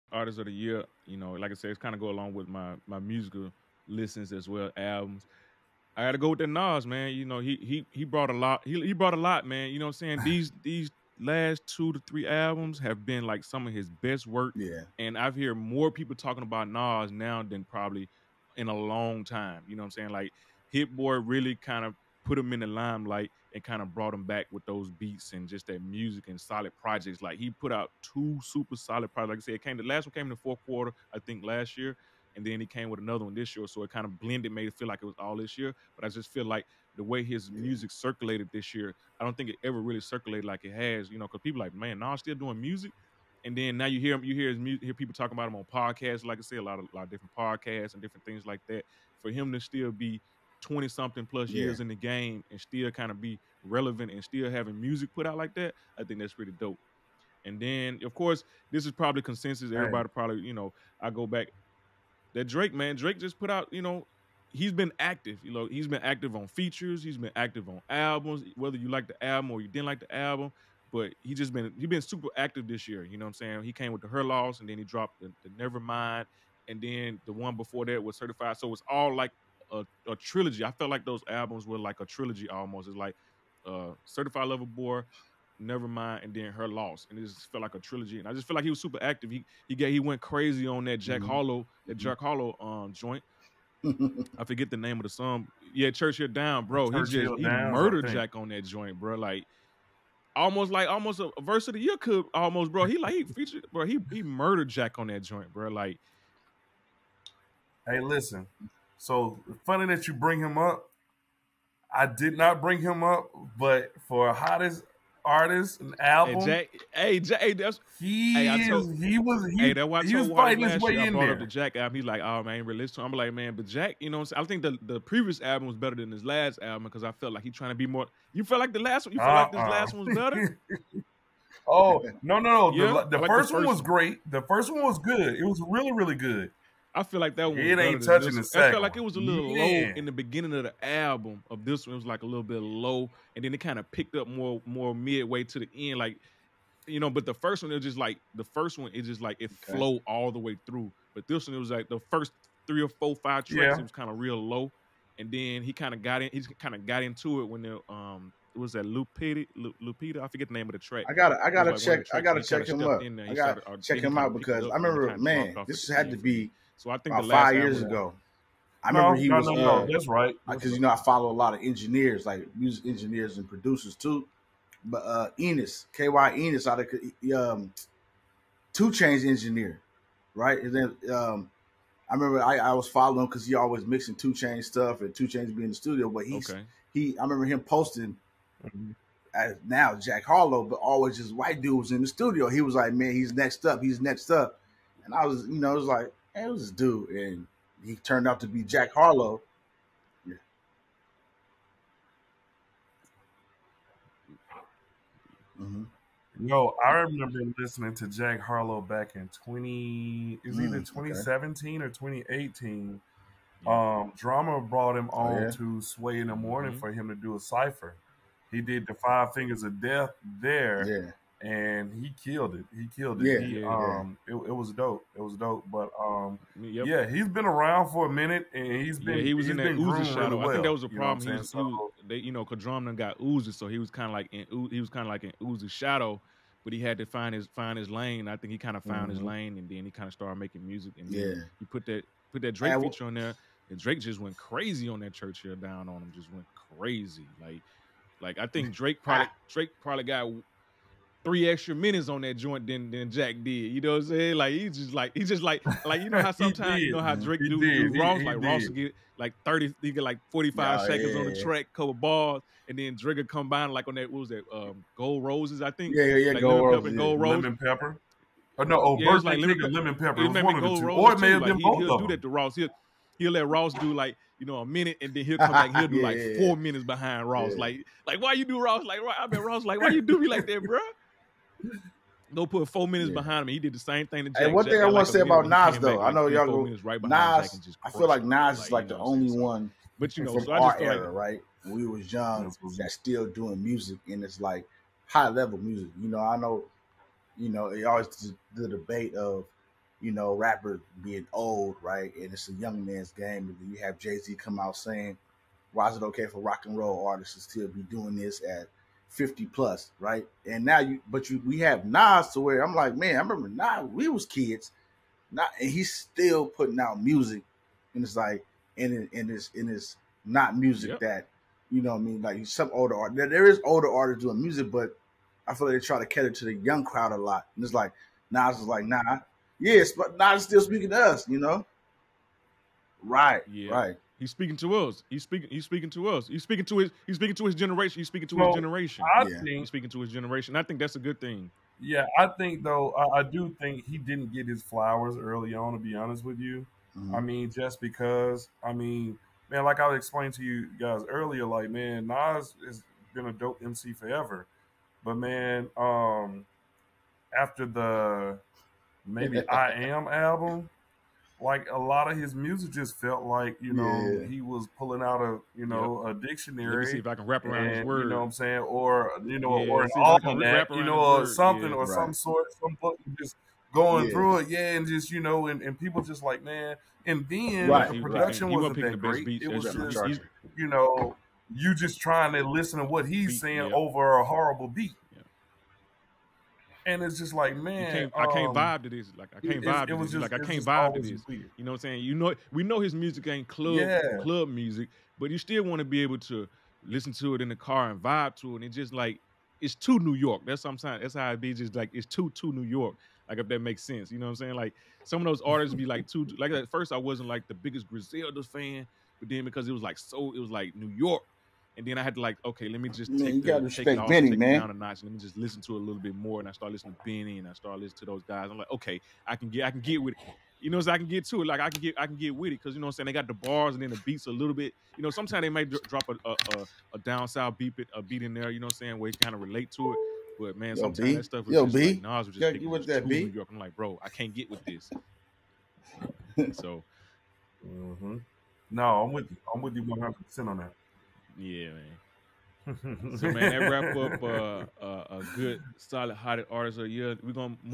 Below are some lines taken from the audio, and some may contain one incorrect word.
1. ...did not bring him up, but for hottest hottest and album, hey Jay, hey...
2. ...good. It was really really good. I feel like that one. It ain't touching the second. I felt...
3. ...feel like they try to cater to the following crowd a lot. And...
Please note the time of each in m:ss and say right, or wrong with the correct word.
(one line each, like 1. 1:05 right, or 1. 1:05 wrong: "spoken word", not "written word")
1. 1:52 wrong: "artist", not "hottest"
2. 2:14 right
3. 5:25 wrong: "young", not "following".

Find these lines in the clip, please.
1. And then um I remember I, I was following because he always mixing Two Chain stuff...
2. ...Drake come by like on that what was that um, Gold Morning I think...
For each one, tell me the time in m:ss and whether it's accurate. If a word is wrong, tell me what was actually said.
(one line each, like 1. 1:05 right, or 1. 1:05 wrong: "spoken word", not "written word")
1. 3:00 right
2. 4:22 wrong: "Roses", not "Morning".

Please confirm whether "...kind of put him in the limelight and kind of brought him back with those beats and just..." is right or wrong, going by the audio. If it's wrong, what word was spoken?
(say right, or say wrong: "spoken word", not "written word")
right.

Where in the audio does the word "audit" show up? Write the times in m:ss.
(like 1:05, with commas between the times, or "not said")
not said.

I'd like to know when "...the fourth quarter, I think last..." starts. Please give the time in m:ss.
0:30.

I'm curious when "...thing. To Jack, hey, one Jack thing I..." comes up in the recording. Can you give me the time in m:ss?
4:44.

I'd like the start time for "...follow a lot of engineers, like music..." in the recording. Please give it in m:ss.
2:50.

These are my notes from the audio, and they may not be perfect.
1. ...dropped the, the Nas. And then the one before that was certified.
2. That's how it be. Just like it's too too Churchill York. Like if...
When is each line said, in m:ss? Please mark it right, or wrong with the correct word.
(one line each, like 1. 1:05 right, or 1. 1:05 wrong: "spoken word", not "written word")
1. 1:14 wrong: "Nevermind", not "Nas"
2. 6:41 wrong: "New", not "Churchill".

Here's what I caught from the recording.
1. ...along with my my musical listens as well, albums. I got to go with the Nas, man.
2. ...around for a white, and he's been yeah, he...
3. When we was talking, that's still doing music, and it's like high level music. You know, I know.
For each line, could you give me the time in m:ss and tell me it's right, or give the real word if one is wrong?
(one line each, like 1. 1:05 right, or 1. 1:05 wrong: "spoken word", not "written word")
1. 0:02 right
2. 3:47 wrong: "minute", not "white"
3. 4:51 wrong: "young", not "talking".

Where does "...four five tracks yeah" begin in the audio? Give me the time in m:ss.
2:32.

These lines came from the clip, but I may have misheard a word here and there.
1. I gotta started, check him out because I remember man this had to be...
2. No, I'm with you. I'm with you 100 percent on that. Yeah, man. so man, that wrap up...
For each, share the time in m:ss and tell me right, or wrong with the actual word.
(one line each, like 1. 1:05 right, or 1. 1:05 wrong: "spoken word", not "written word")
1. 2:42 right
2. 7:18 right.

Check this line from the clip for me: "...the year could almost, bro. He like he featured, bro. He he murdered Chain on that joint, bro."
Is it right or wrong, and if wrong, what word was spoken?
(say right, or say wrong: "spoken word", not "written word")
wrong: "Jack", not "Chain".